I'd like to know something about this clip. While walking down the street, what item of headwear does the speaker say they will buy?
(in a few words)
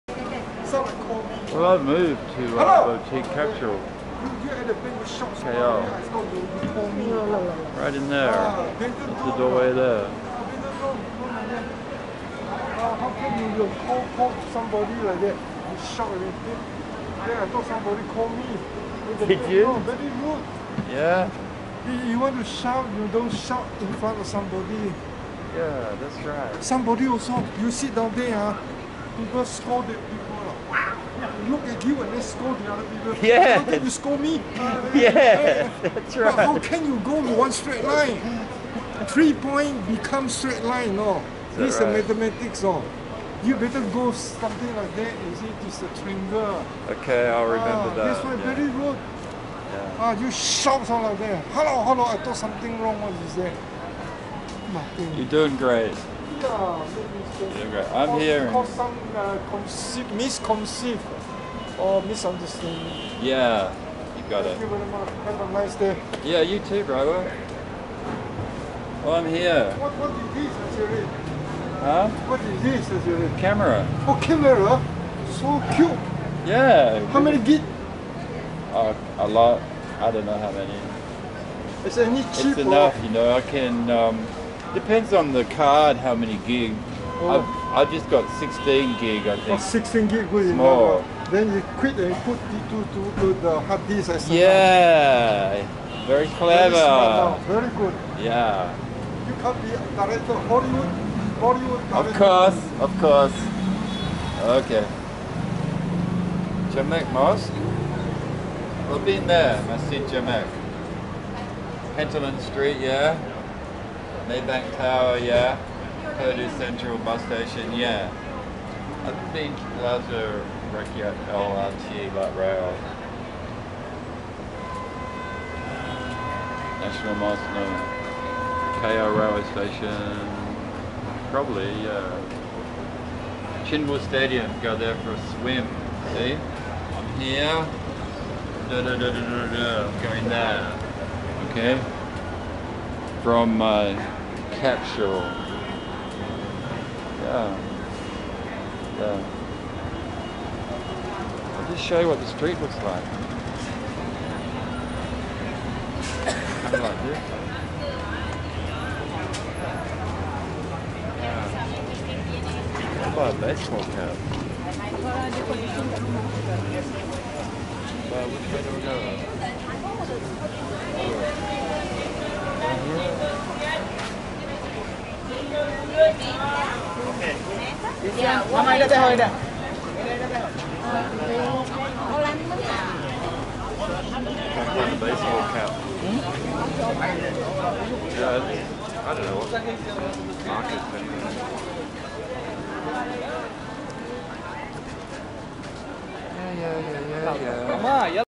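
baseball cap.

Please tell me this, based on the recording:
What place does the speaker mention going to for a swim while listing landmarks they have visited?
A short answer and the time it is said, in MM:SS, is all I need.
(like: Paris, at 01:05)
Chin Woo Stadium, at 02:13.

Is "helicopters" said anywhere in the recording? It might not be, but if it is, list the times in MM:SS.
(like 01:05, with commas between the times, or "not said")
not said.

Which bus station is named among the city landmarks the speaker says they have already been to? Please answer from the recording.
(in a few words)
Pudu Sentral.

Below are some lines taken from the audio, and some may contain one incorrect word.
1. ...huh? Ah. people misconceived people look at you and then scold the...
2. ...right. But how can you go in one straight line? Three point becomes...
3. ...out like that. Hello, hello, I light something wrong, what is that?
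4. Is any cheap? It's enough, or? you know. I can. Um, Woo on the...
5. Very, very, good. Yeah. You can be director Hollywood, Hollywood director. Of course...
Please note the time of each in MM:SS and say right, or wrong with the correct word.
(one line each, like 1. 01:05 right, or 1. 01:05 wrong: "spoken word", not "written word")
1. 00:28 wrong: "scolded", not "misconceived"
2. 00:36 right
3. 00:50 wrong: "thought", not "light"
4. 01:21 wrong: "Depends", not "Woo"
5. 01:37 right.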